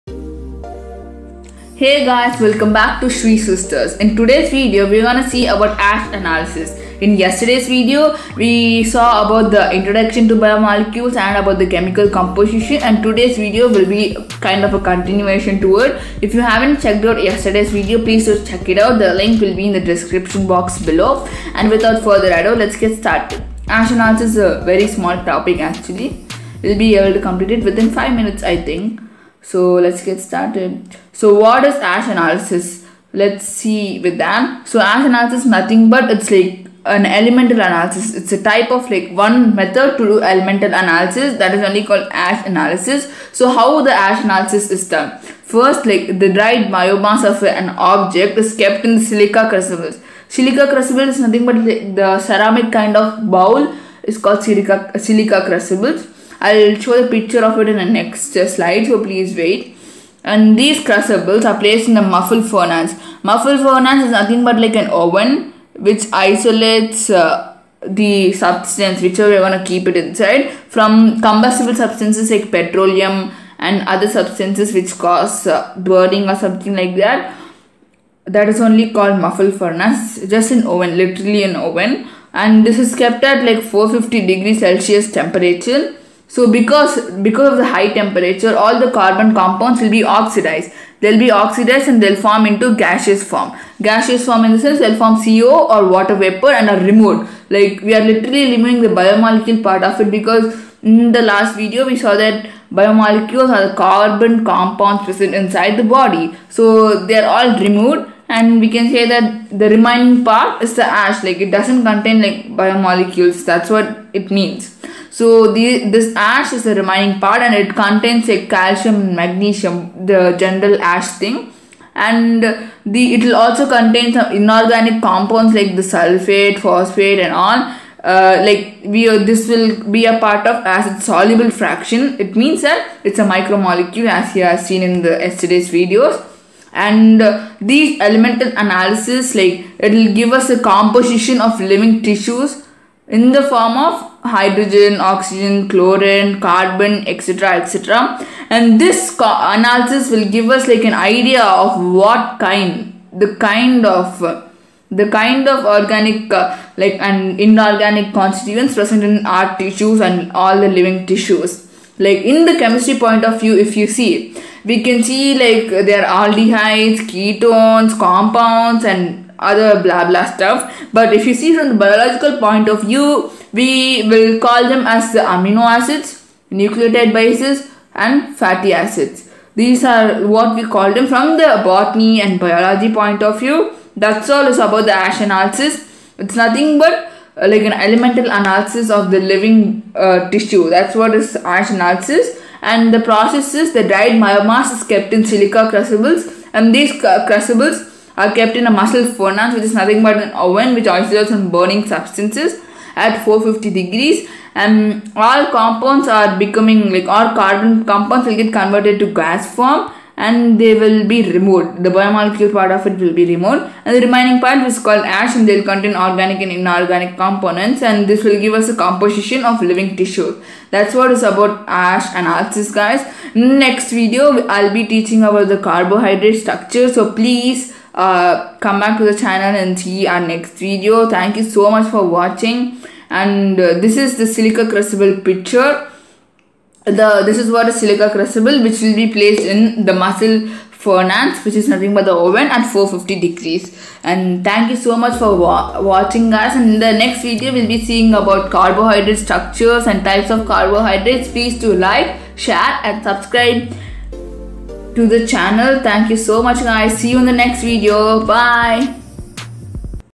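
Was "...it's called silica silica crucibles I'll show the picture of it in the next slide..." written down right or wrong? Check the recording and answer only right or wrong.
right.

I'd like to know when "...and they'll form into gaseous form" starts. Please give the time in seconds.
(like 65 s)
91 s.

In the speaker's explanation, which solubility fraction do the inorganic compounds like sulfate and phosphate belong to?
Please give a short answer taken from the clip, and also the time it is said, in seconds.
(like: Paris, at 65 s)
Acid soluble fraction, at 130 s.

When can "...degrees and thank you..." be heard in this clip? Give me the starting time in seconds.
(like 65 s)
243 s.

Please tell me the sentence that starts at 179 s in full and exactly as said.
These are what we call them from the botany and biology point of view.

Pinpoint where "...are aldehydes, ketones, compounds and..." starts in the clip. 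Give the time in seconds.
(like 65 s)
166 s.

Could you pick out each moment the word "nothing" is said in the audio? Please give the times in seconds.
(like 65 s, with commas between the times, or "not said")
35 s, 51 s, 64 s, 186 s, 199 s, 241 s.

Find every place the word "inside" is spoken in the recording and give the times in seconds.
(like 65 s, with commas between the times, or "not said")
69 s, 105 s.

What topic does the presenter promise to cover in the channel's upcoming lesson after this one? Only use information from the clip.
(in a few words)
Carbohydrate structure.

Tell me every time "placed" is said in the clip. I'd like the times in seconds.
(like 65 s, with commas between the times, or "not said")
61 s, 239 s.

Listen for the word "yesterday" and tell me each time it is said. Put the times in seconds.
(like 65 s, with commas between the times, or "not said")
7 s, 17 s, 135 s.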